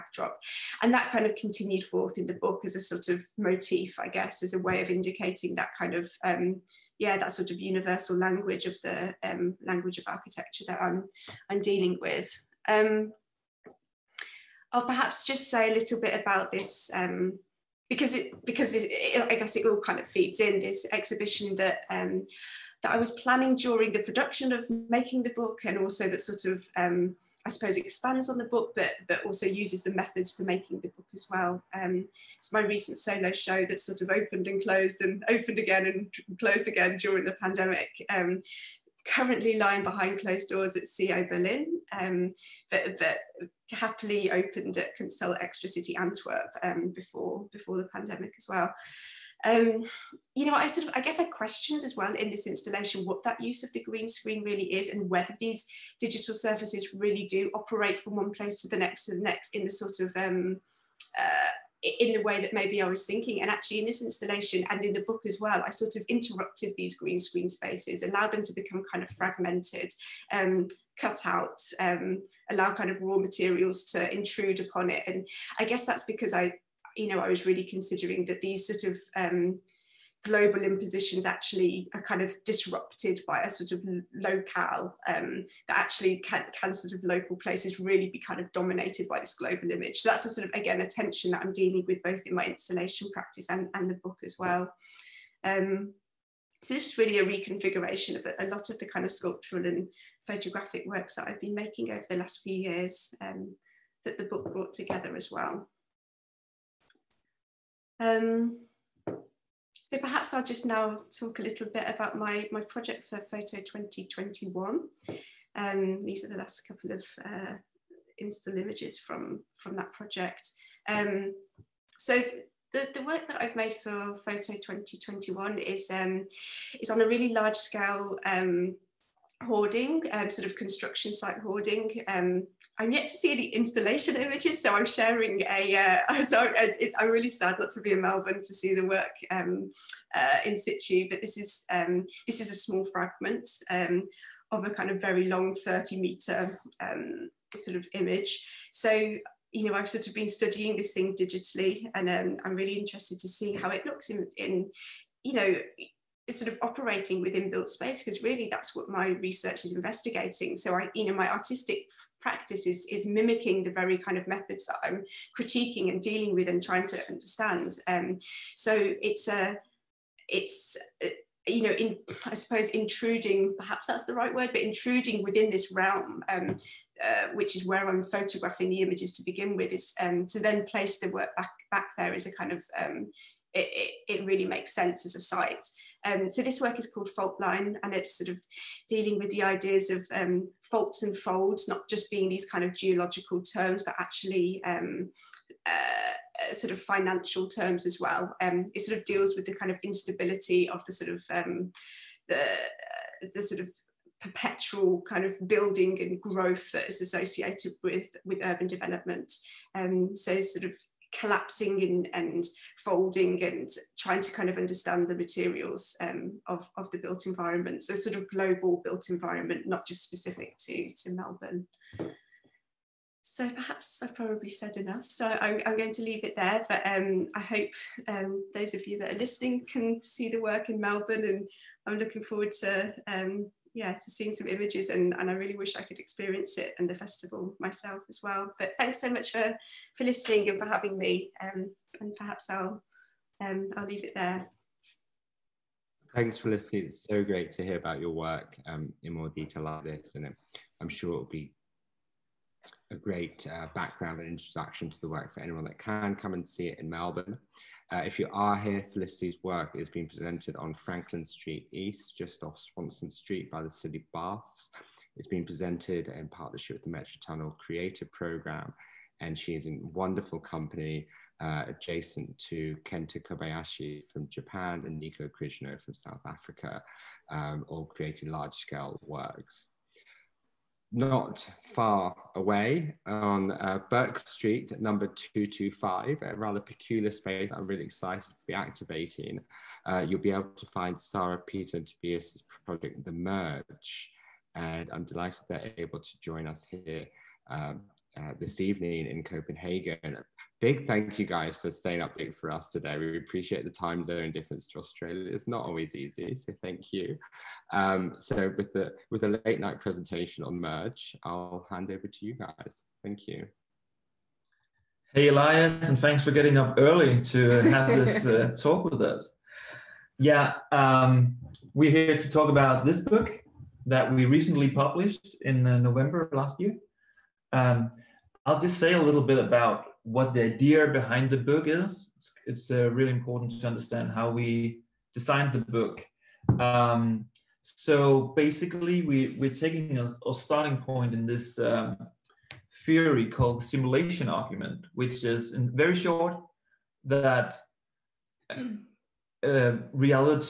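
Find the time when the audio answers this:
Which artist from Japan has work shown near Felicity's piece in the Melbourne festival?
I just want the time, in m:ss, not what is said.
4:32.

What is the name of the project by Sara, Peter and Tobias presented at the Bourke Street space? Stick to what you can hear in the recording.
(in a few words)
The Merge.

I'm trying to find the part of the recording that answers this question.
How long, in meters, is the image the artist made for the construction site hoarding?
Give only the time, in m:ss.
2:25.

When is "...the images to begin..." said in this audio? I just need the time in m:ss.
2:58.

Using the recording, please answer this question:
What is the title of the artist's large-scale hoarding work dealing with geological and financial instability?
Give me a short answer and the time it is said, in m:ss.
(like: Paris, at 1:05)
Fault Line, at 3:07.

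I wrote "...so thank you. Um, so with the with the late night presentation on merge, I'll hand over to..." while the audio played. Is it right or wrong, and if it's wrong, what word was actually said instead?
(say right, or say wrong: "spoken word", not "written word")
right.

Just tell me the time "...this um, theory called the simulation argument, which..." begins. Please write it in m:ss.
5:41.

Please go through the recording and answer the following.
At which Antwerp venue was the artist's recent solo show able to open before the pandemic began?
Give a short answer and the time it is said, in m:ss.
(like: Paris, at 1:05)
Kunsthalle Extra City, at 0:44.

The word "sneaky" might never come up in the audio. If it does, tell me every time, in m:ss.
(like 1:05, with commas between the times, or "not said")
not said.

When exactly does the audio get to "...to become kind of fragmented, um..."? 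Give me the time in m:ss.
1:08.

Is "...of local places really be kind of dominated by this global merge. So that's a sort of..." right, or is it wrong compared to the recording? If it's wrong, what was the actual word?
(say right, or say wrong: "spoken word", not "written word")
wrong: "image", not "merge".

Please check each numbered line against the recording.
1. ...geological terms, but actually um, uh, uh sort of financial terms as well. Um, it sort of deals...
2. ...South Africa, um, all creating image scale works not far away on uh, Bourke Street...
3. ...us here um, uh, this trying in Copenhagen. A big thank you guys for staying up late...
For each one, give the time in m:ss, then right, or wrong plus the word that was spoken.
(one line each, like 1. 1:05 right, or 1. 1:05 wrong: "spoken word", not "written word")
1. 3:12 right
2. 4:35 wrong: "large", not "image"
3. 4:56 wrong: "evening", not "trying".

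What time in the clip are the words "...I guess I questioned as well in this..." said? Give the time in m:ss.
0:50.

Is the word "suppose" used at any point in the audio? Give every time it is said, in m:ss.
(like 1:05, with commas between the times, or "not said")
0:27, 2:52.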